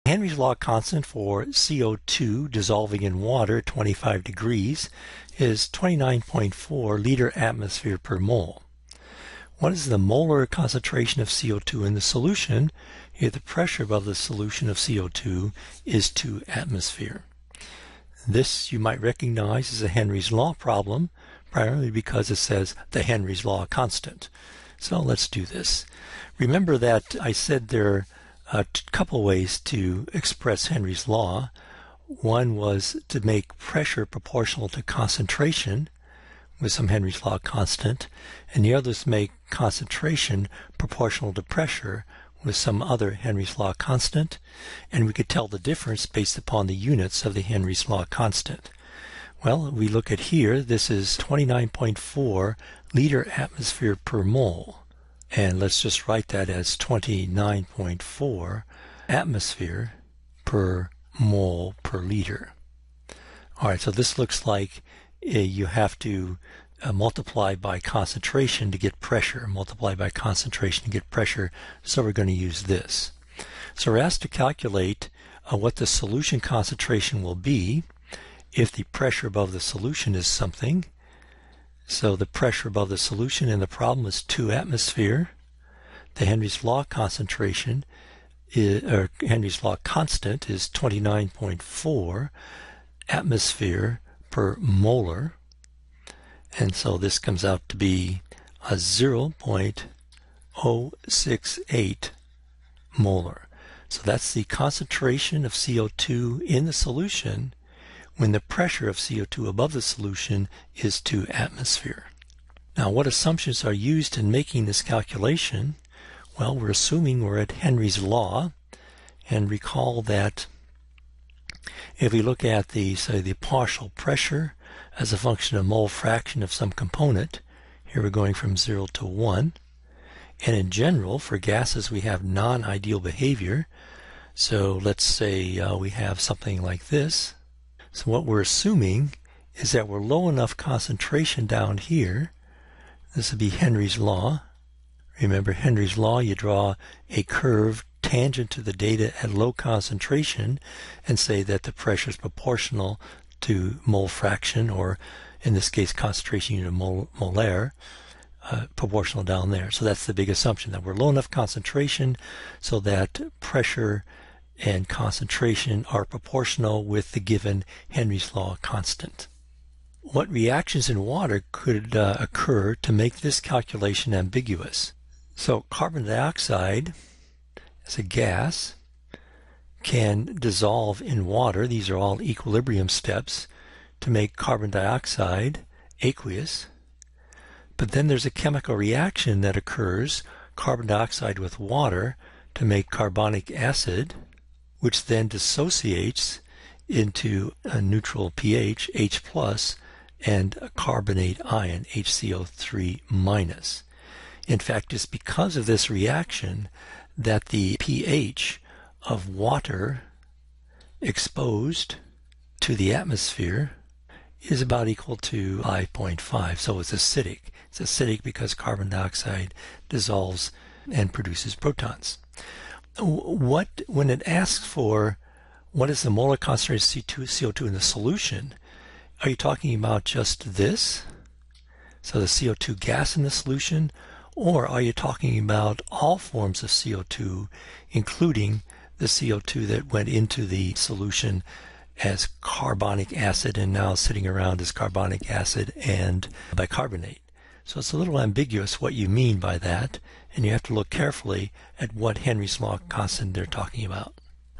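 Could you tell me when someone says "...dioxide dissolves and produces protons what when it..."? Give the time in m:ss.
3:38.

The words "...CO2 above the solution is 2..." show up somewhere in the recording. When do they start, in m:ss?
1:48.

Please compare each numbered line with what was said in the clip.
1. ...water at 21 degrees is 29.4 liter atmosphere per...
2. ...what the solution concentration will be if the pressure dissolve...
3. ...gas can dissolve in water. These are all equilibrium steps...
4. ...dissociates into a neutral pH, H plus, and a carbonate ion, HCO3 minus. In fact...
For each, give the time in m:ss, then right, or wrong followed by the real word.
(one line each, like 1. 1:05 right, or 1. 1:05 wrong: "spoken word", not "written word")
1. 0:03 wrong: "25", not "21"
2. 1:15 wrong: "above", not "dissolve"
3. 2:58 right
4. 3:15 right.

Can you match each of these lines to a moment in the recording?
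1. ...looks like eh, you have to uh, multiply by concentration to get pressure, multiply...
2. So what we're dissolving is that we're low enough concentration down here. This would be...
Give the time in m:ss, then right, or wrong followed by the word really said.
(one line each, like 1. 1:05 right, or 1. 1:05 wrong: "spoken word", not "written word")
1. 1:04 right
2. 2:17 wrong: "assuming", not "dissolving".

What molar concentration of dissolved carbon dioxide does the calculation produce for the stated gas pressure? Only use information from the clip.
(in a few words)
0.068 molar.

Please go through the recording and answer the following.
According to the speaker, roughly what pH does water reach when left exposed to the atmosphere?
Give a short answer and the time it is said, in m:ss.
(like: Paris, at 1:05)
5.5, at 3:35.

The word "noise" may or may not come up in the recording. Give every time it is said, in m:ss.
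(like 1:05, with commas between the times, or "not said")
not said.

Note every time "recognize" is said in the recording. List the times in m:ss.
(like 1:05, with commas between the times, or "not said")
0:18.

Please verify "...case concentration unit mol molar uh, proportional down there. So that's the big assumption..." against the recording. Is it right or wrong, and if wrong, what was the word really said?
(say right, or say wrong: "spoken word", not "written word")
right.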